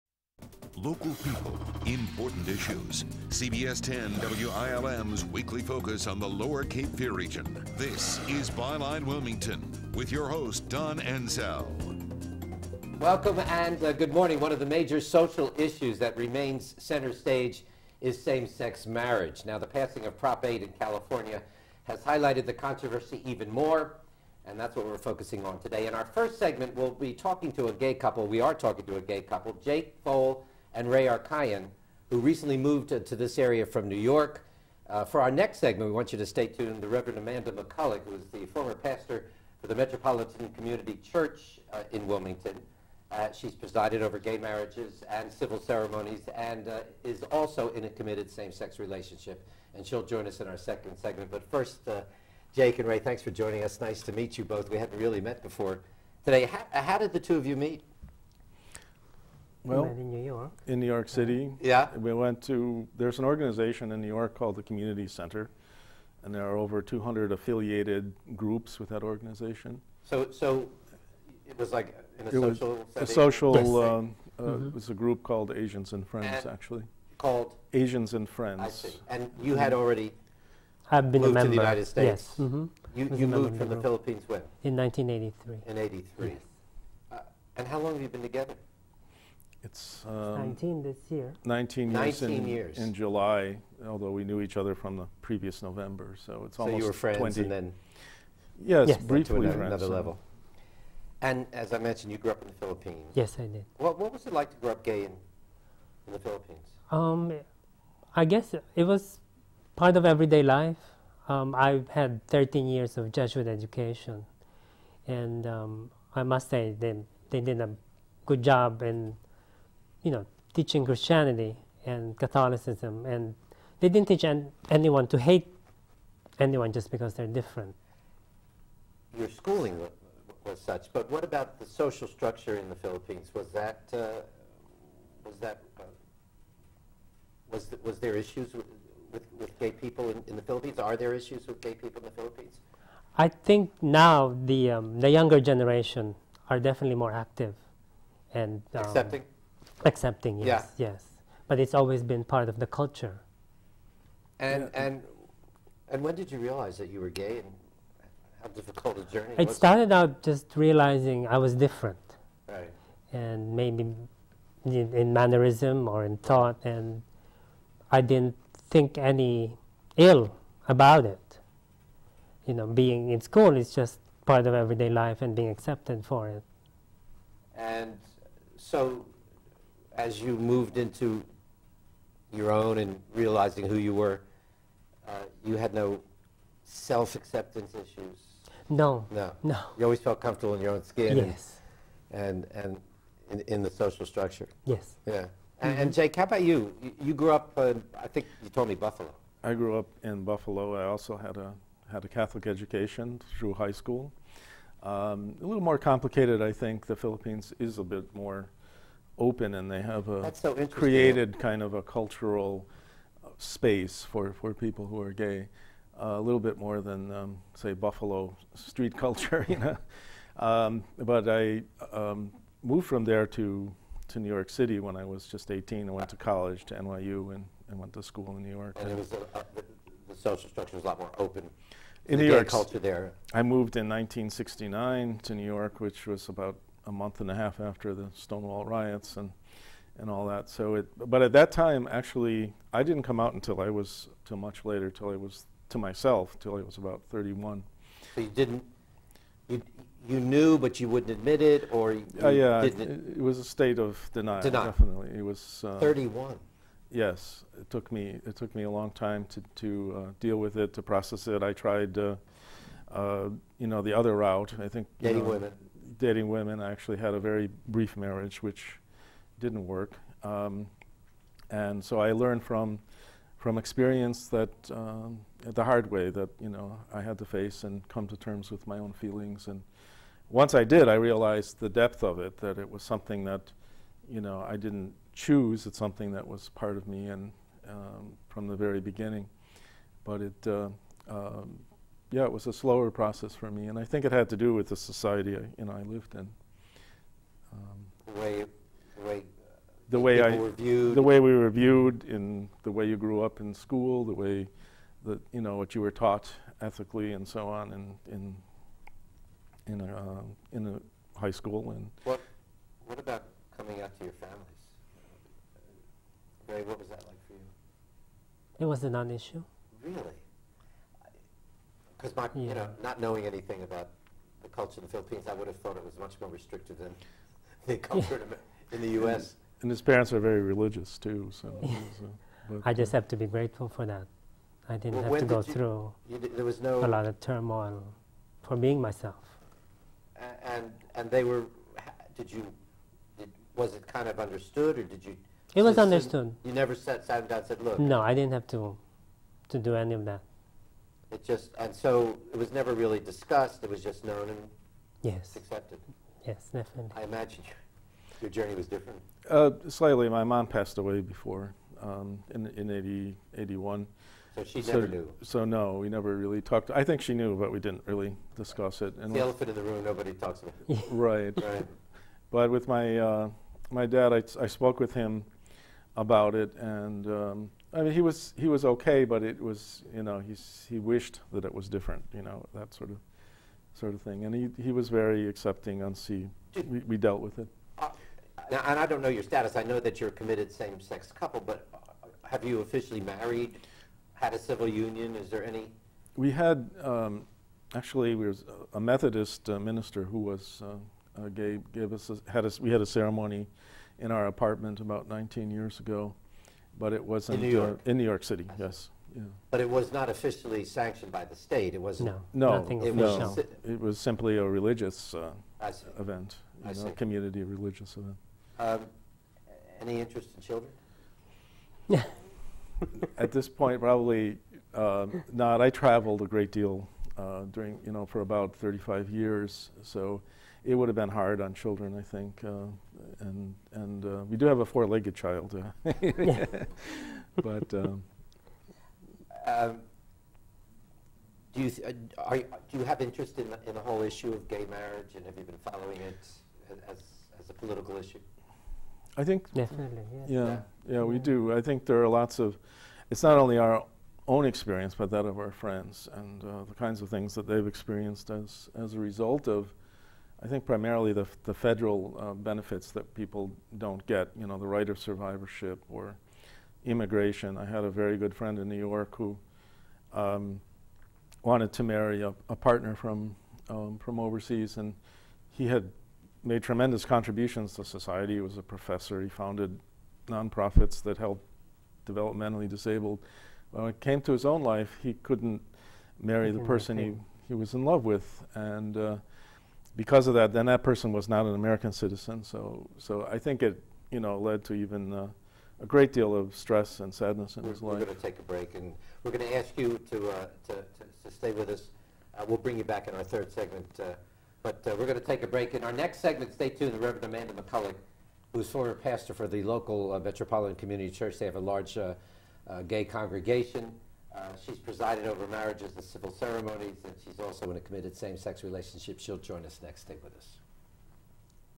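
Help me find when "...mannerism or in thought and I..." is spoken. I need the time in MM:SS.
02:45.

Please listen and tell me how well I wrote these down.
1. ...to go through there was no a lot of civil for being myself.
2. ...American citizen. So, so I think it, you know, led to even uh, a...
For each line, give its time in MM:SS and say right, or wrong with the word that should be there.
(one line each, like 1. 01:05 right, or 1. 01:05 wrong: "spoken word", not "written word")
1. 05:35 wrong: "turmoil", not "civil"
2. 08:11 right.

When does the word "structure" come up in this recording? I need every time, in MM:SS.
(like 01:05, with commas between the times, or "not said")
02:12, 03:14, 03:50.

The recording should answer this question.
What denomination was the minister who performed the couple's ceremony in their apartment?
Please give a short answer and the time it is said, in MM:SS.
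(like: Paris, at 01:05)
Methodist, at 06:38.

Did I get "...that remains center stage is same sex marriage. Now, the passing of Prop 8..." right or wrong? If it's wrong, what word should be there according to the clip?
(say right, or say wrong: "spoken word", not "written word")
right.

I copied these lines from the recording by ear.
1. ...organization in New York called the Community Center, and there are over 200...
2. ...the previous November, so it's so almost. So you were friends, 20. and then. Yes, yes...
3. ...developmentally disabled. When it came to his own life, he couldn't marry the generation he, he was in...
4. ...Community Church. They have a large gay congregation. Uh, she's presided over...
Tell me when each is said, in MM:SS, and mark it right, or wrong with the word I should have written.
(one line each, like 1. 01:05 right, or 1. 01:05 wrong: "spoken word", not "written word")
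1. 01:03 right
2. 01:34 right
3. 08:02 wrong: "person", not "generation"
4. 08:30 right.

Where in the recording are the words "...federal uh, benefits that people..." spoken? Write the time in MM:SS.
07:41.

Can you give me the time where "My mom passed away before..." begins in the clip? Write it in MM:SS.
06:00.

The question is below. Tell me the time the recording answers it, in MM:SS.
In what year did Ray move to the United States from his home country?
01:24.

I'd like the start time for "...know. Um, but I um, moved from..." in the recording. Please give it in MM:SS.
03:39.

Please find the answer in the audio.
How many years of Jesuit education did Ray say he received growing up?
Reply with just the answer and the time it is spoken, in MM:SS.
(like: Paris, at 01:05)
13, at 01:52.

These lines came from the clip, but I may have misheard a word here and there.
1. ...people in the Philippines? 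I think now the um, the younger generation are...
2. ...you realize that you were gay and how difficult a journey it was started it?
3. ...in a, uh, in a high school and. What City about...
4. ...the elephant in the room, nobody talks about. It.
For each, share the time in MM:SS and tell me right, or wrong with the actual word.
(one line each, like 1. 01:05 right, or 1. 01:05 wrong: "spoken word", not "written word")
1. 02:21 right
2. 02:36 right
3. 05:09 wrong: "What", not "City"
4. 06:09 right.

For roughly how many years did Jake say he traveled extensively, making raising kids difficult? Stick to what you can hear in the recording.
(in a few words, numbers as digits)
35.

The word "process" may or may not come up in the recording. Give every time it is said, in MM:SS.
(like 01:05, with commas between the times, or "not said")
04:20, 04:52.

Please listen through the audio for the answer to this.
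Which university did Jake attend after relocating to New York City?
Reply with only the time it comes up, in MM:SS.
03:46.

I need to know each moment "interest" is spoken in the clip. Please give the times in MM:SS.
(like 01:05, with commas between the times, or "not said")
06:59, 07:23.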